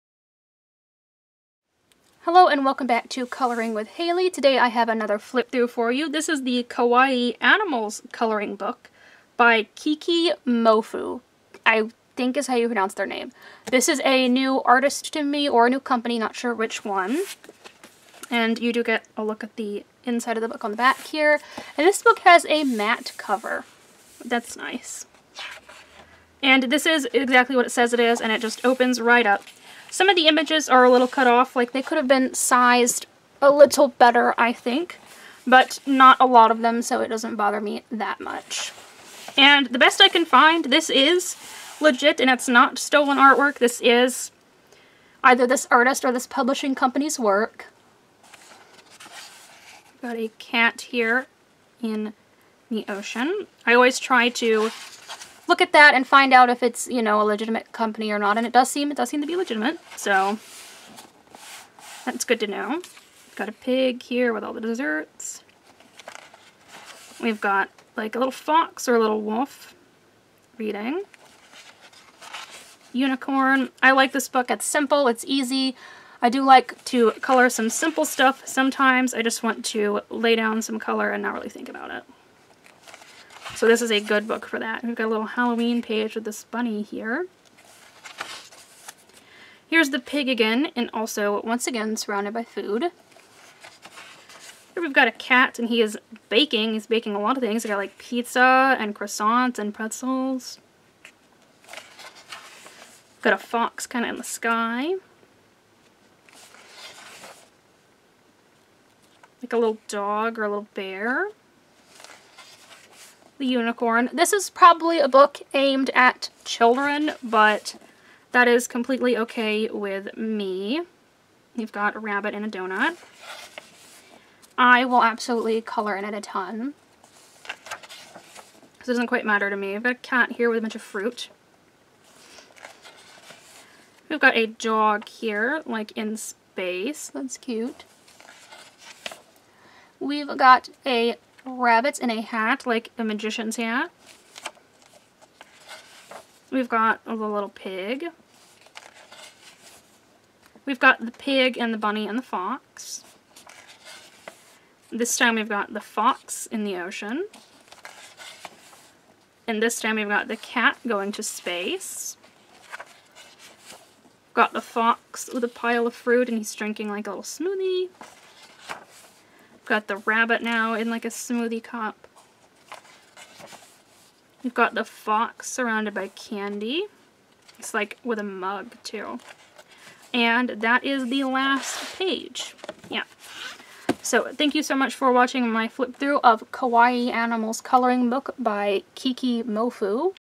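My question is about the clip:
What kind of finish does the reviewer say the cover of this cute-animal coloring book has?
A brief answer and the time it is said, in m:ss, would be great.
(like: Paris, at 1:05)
Matte, at 0:22.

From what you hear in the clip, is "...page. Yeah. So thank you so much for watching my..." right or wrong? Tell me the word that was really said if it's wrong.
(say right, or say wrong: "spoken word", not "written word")
right.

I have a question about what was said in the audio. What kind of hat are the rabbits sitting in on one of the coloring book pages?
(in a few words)
Magician's hat.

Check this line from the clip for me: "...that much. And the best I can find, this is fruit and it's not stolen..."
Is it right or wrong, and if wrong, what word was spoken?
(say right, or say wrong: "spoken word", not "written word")
wrong: "legit", not "fruit".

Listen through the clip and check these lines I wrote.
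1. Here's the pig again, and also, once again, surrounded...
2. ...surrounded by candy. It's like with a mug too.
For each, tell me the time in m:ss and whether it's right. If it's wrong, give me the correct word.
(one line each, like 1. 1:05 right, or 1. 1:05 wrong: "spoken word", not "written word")
1. 1:29 right
2. 2:55 right.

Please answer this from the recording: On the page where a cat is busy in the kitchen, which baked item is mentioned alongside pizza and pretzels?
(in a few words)
Croissants.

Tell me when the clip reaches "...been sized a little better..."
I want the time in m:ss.
0:32.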